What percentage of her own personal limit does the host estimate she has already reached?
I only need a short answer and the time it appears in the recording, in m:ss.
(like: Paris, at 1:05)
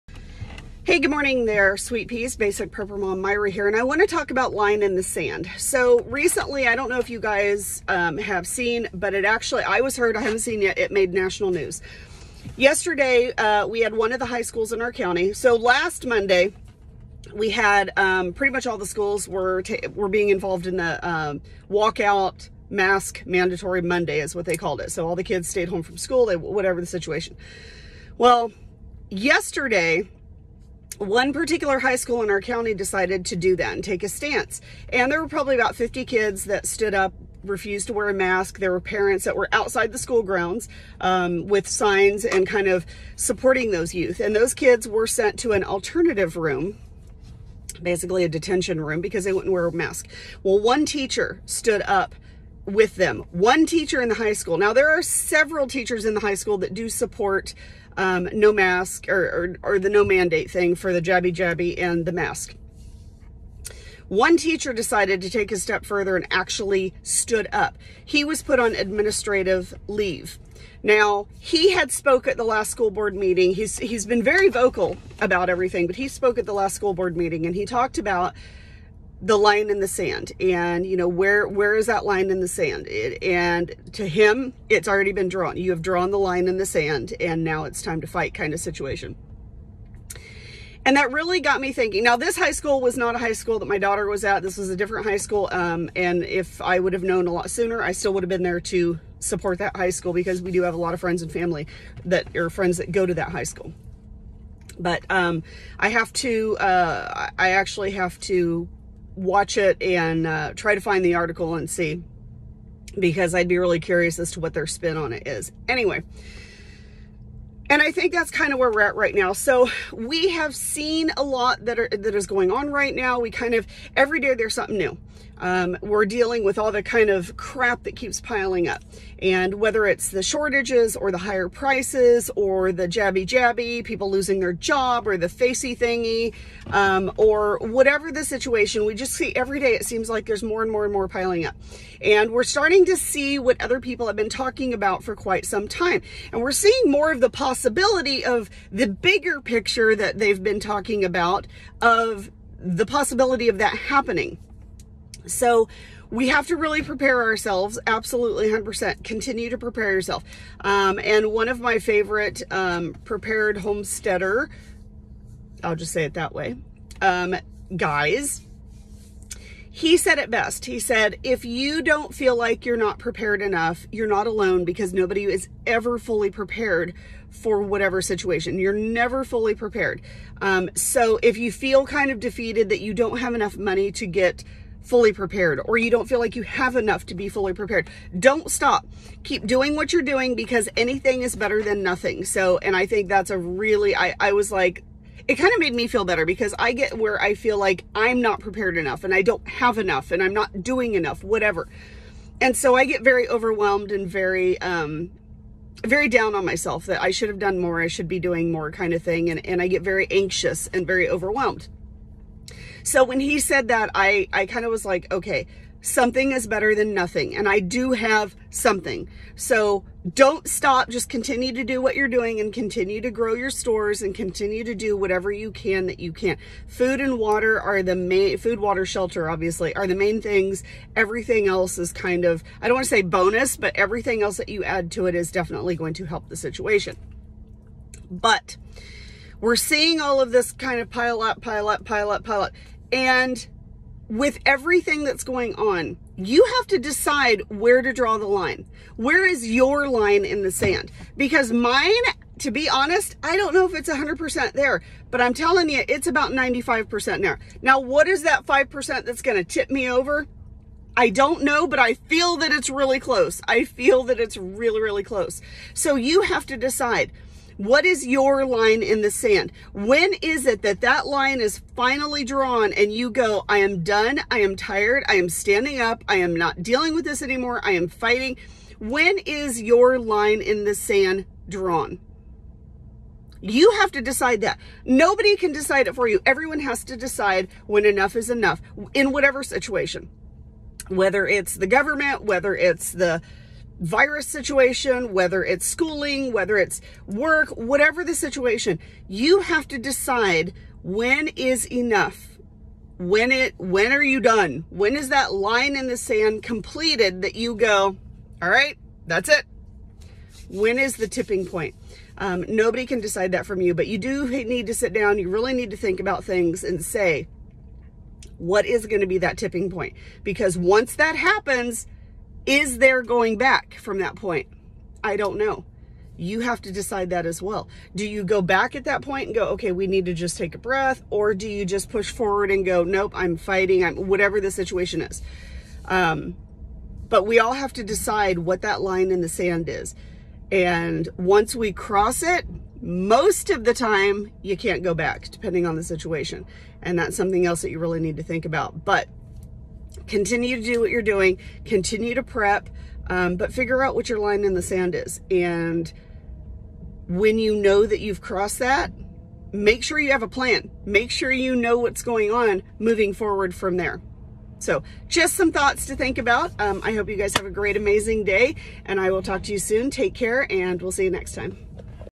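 95%, at 4:16.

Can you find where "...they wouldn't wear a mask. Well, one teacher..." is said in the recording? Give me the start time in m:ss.
0:49.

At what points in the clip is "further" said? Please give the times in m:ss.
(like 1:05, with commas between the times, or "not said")
1:05.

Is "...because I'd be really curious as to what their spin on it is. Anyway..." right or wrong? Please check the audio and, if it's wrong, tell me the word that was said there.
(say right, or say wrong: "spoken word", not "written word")
right.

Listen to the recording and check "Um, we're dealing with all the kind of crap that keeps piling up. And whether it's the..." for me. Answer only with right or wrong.
right.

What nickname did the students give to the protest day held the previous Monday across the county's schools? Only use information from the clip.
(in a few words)
Mask Mandatory Monday.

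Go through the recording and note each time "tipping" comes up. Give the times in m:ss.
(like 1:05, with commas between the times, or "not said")
5:11, 5:19.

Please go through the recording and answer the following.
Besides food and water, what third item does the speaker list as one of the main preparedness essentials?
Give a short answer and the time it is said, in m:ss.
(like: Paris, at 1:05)
Shelter, at 3:48.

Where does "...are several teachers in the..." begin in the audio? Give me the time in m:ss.
0:54.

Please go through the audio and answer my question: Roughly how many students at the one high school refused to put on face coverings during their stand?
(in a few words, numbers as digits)
50.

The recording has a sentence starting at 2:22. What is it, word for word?
And we're starting to see what other people have been talking about for quite some time.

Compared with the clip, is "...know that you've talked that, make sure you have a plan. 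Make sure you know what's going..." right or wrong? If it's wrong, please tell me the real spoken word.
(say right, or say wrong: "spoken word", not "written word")
wrong: "crossed", not "talked".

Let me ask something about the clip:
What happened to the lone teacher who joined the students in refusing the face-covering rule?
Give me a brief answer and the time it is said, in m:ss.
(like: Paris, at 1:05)
Administrative leave, at 1:08.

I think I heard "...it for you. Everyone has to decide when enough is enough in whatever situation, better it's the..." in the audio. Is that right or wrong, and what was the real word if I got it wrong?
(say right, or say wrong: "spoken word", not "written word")
wrong: "whether", not "better".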